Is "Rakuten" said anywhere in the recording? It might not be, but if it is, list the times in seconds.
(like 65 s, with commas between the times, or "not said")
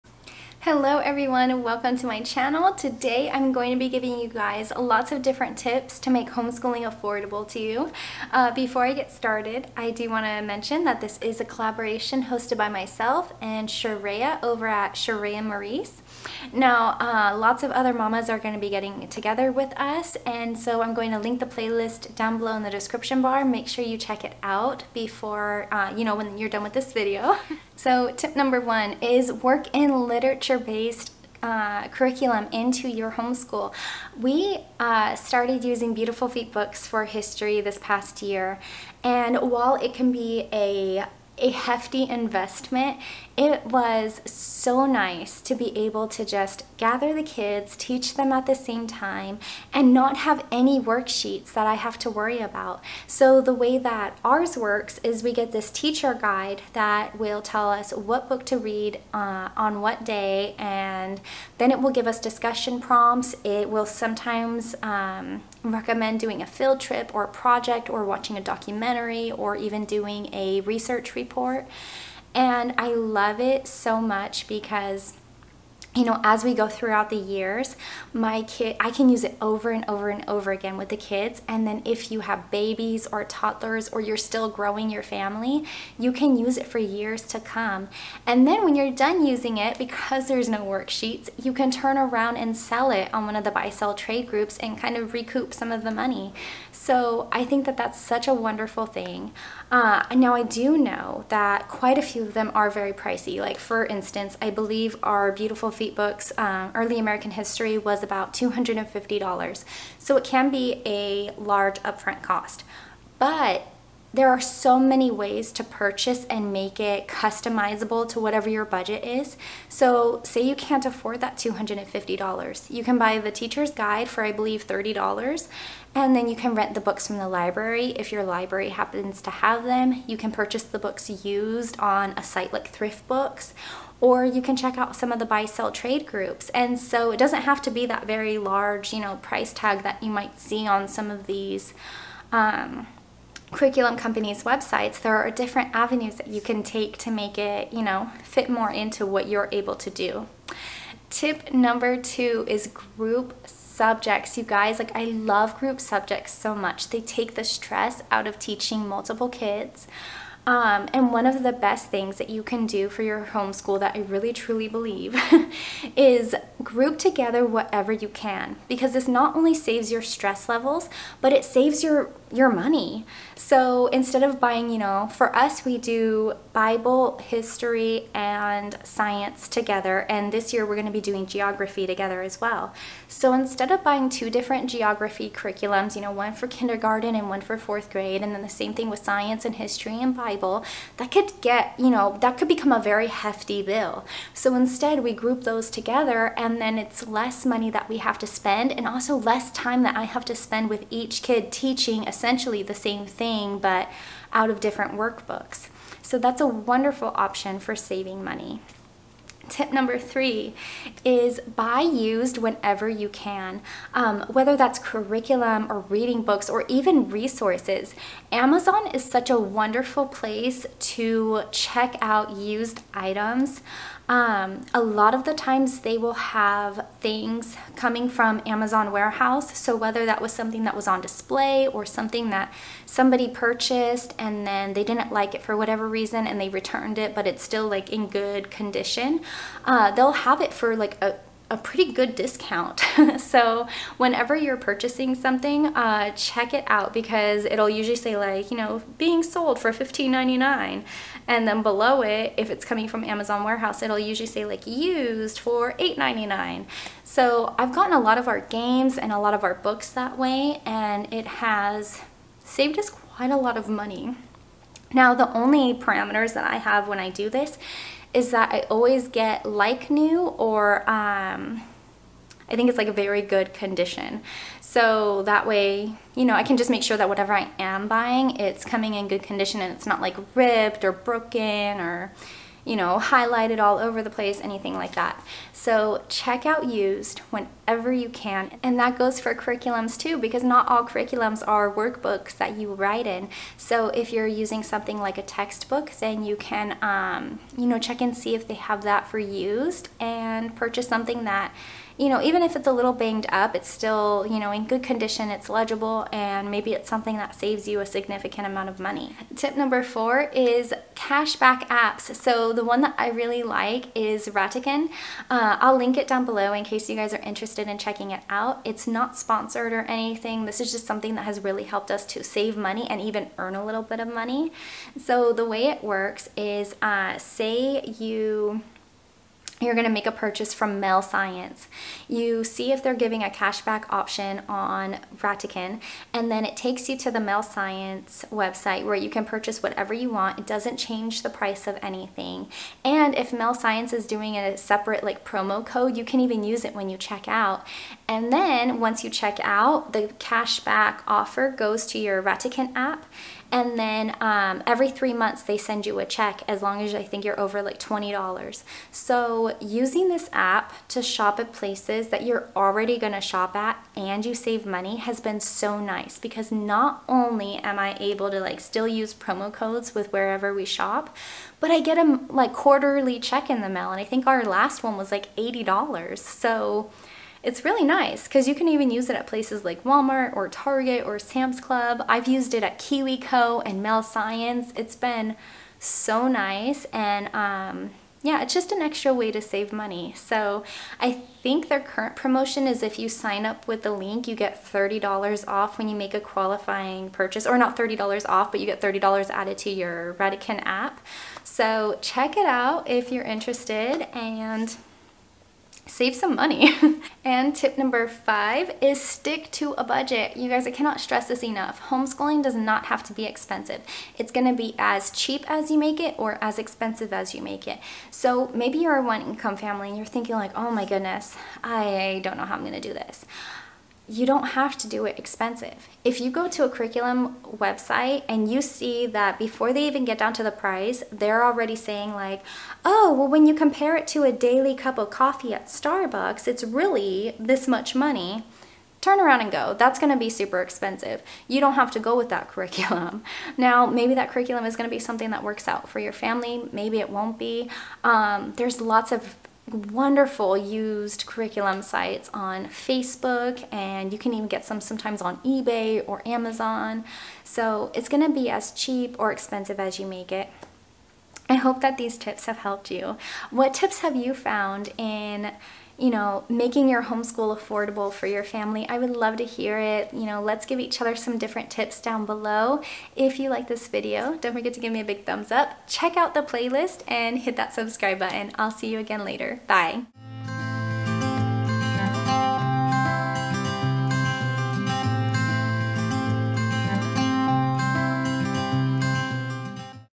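314 s, 335 s, 352 s, 400 s.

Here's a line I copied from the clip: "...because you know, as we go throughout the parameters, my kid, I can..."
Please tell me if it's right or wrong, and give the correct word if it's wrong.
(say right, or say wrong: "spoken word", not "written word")
wrong: "years", not "parameters".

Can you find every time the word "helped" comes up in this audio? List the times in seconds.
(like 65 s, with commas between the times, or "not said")
321 s, 462 s.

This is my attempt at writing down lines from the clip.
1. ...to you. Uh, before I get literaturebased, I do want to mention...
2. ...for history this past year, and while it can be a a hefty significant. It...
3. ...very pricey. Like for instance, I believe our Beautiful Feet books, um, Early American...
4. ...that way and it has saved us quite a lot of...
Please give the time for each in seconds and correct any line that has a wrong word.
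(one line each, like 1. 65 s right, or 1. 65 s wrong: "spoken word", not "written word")
1. 7 s wrong: "started", not "literaturebased"
2. 36 s wrong: "investment", not "significant"
3. 102 s right
4. 259 s right.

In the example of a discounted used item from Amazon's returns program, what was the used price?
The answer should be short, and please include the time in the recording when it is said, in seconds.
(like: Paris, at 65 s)
$8.99, at 255 s.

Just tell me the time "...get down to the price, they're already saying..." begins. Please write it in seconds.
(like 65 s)
430 s.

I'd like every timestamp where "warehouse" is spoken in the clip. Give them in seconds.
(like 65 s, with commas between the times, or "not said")
228 s, 253 s.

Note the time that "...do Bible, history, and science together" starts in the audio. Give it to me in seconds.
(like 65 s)
175 s.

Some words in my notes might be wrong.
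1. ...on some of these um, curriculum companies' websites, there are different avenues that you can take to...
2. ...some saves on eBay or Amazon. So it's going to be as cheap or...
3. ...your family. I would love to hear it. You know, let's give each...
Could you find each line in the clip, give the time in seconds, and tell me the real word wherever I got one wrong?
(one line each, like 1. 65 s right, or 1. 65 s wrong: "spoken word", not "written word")
1. 140 s right
2. 454 s wrong: "sometimes", not "saves"
3. 468 s right.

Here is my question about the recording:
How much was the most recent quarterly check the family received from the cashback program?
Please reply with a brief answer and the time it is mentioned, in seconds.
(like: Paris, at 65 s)
$80, at 375 s.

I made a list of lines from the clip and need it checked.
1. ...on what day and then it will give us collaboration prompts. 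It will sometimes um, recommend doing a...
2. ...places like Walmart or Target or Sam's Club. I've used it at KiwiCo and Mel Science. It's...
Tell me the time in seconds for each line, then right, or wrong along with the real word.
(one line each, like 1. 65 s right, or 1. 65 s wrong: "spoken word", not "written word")
1. 59 s wrong: "discussion", not "collaboration"
2. 379 s right.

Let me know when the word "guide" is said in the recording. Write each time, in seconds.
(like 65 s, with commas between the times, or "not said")
56 s, 123 s.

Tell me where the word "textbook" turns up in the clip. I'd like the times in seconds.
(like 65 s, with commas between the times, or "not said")
295 s.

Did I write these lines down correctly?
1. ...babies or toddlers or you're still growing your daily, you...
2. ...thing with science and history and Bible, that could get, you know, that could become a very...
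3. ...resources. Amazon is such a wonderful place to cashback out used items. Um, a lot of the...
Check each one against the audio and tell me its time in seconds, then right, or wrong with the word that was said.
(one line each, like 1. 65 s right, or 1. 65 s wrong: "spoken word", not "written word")
1. 82 s wrong: "family", not "daily"
2. 188 s right
3. 217 s wrong: "check", not "cashback".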